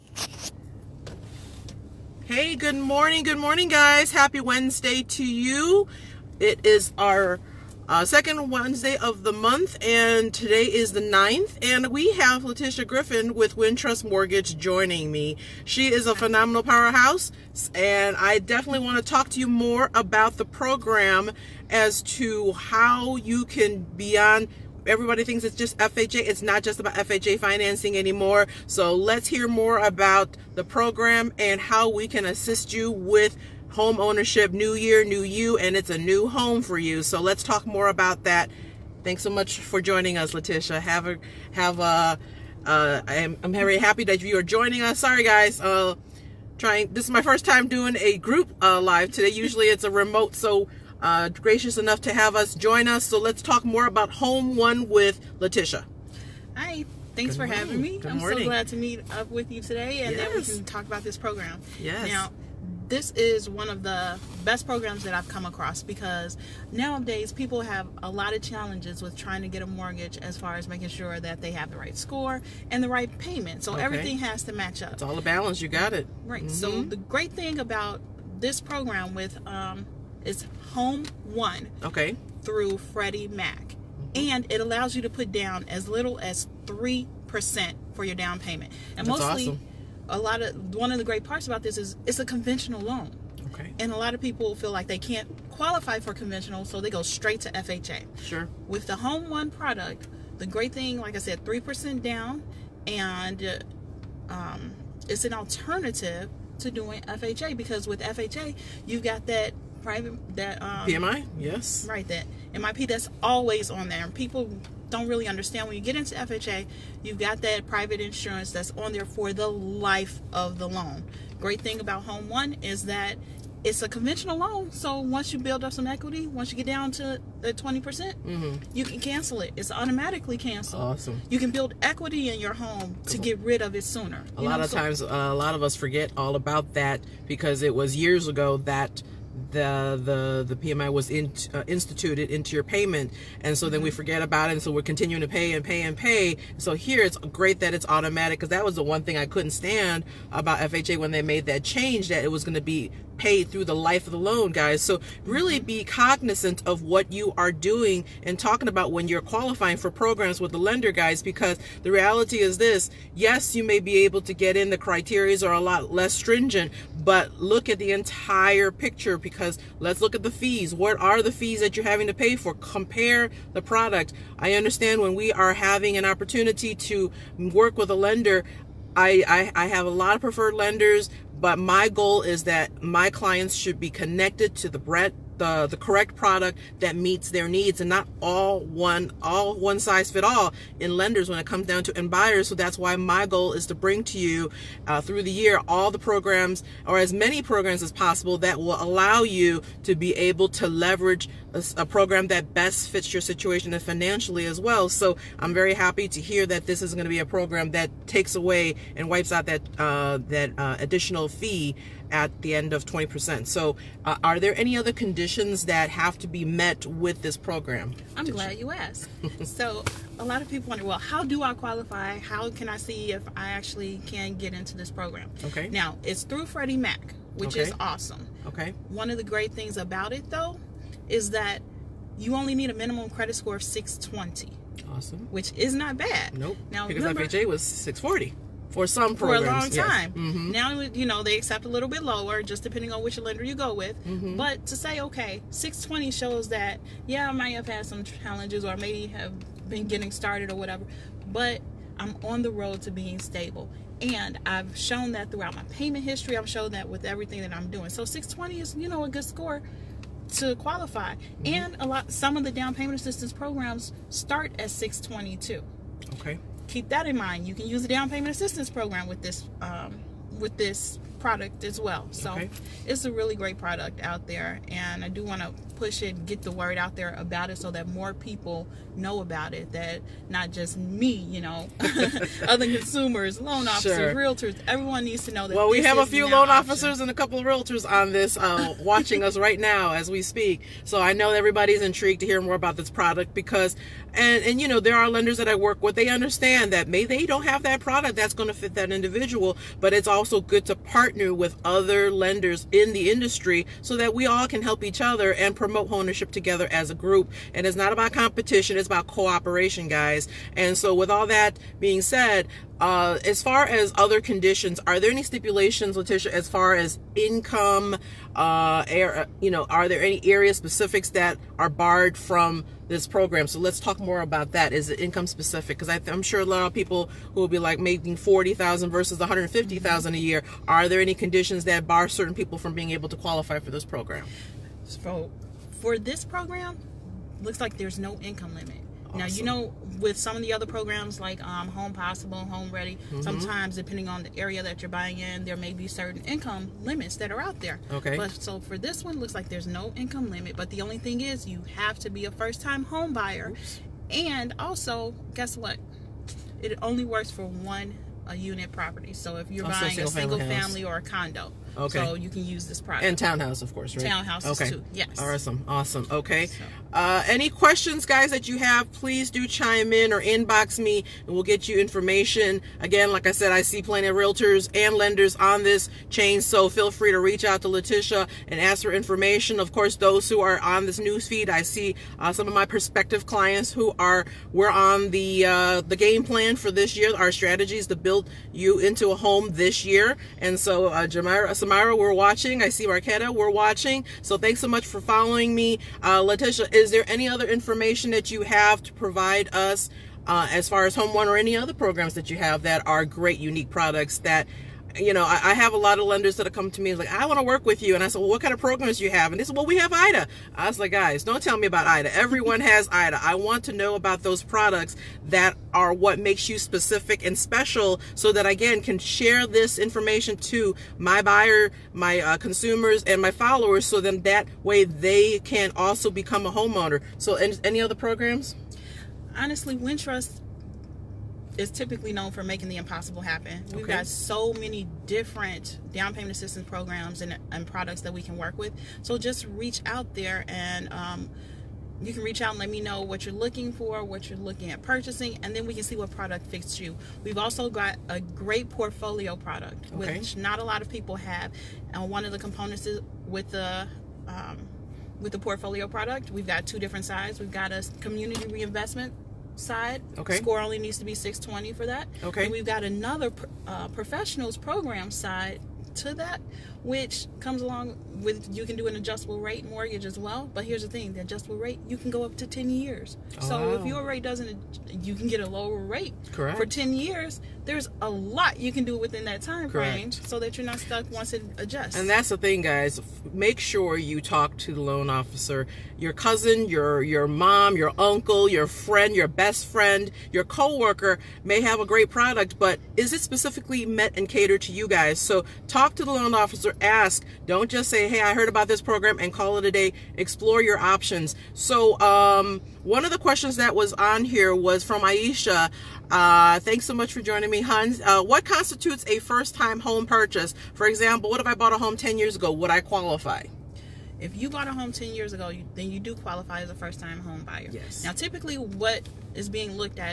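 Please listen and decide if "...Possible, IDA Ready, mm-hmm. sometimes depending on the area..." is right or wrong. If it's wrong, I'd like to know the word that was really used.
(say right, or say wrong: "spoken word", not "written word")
wrong: "Home", not "IDA".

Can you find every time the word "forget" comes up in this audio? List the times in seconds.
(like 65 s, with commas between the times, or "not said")
135 s, 143 s.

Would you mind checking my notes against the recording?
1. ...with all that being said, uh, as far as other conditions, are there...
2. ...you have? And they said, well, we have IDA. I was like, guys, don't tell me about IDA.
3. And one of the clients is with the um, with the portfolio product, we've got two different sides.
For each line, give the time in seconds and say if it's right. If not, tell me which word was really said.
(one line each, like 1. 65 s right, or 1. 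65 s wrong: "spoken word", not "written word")
1. 310 s right
2. 409 s right
3. 451 s wrong: "components", not "clients".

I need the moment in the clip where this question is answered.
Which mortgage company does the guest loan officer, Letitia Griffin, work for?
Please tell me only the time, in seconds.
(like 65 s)
13 s.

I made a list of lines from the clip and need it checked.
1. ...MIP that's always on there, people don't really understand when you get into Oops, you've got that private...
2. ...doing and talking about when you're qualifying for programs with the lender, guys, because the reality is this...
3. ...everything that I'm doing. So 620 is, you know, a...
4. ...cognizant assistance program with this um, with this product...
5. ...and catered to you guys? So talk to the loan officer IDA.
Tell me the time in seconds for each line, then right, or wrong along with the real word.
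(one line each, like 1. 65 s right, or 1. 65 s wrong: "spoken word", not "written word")
1. 112 s wrong: "FHA", not "Oops"
2. 157 s right
3. 257 s right
4. 268 s wrong: "payment", not "cognizant"
5. 494 s wrong: "Ask", not "IDA".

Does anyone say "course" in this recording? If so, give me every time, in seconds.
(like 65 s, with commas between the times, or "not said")
363 s, 379 s.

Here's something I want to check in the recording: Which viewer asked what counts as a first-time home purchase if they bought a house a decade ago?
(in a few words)
Aisha.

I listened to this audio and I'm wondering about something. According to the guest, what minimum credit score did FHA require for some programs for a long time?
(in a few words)
640.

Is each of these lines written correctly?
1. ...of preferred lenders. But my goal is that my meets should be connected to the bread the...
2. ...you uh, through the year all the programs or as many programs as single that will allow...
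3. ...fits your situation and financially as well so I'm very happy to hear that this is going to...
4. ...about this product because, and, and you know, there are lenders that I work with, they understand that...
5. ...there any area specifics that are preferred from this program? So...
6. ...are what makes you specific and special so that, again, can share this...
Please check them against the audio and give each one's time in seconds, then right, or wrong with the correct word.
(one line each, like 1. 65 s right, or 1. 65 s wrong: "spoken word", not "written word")
1. 180 s wrong: "clients", not "meets"
2. 194 s wrong: "possible", not "single"
3. 202 s right
4. 292 s right
5. 319 s wrong: "barred", not "preferred"
6. 415 s right.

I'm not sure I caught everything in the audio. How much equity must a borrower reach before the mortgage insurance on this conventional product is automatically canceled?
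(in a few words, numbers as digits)
20%.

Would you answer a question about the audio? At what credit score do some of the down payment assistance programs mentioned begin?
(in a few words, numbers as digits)
622.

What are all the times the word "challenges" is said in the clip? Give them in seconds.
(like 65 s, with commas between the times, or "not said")
68 s, 248 s.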